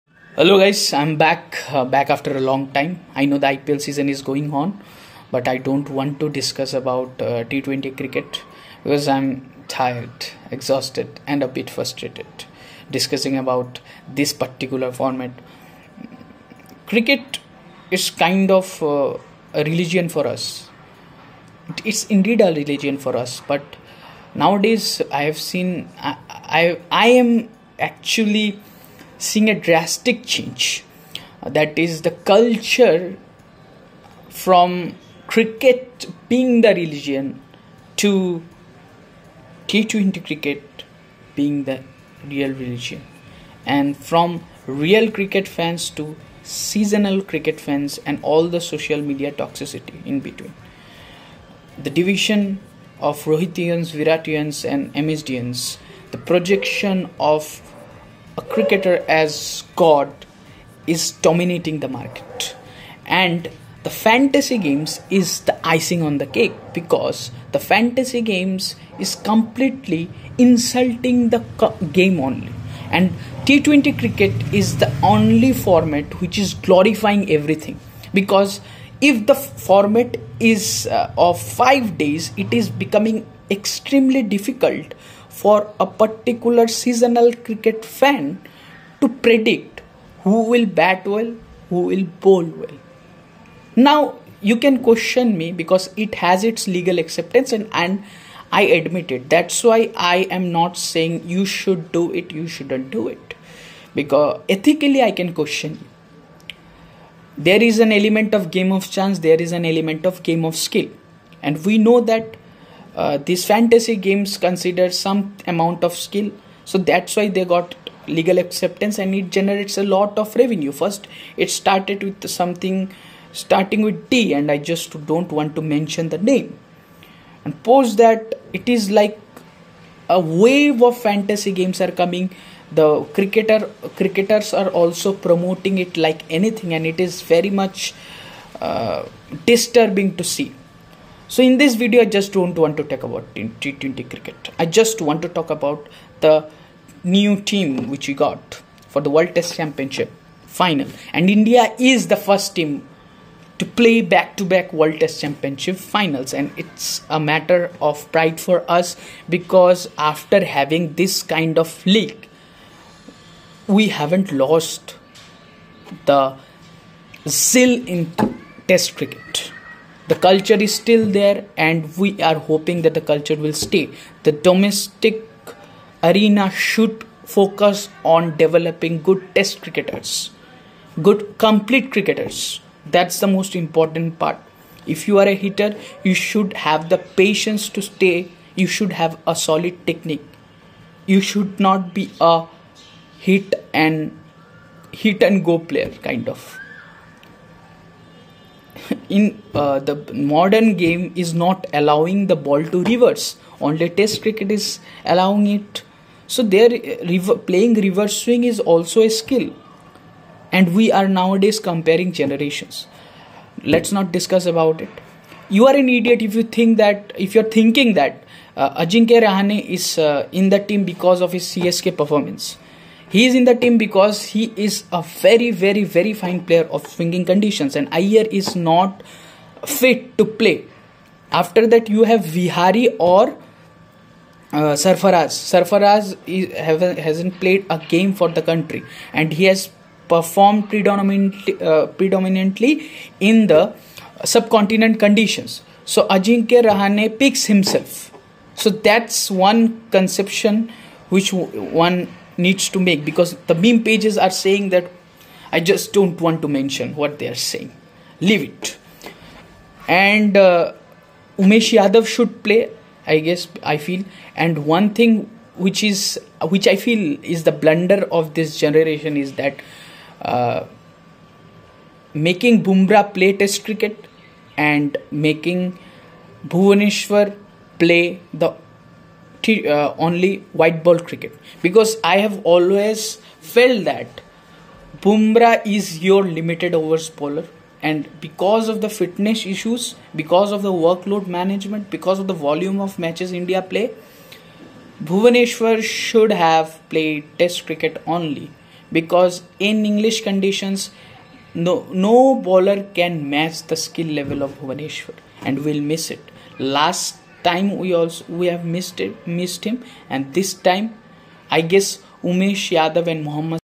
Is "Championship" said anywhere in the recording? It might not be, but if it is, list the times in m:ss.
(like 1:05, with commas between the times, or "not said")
2:29, 2:35.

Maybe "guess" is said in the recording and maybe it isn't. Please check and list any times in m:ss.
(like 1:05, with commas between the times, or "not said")
4:23, 5:11.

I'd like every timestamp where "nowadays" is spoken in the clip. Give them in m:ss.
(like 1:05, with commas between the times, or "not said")
0:24, 3:31.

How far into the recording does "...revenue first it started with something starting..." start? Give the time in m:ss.
2:00.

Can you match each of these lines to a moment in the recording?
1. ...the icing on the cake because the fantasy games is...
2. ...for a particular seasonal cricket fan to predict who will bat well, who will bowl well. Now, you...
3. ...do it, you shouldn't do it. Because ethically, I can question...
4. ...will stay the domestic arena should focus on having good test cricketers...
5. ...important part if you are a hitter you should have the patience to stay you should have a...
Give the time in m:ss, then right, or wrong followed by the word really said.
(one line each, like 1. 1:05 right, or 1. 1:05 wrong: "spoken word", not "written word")
1. 1:05 right
2. 1:25 right
3. 1:41 right
4. 2:53 wrong: "developing", not "having"
5. 3:03 right.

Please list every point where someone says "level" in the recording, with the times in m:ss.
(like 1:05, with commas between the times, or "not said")
5:04.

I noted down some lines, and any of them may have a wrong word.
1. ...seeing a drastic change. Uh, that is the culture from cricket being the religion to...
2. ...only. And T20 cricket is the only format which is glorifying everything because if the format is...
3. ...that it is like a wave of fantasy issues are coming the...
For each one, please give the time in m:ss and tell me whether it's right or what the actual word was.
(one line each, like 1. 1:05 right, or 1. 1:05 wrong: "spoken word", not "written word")
1. 0:29 right
2. 1:12 right
3. 2:07 wrong: "games", not "issues".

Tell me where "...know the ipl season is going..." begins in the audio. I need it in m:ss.
0:03.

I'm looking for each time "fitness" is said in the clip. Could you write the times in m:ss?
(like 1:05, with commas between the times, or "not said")
4:48.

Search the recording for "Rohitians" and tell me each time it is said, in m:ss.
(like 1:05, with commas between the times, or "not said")
0:53.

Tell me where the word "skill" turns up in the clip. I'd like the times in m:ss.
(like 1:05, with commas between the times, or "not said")
1:50, 1:55, 3:29, 5:03.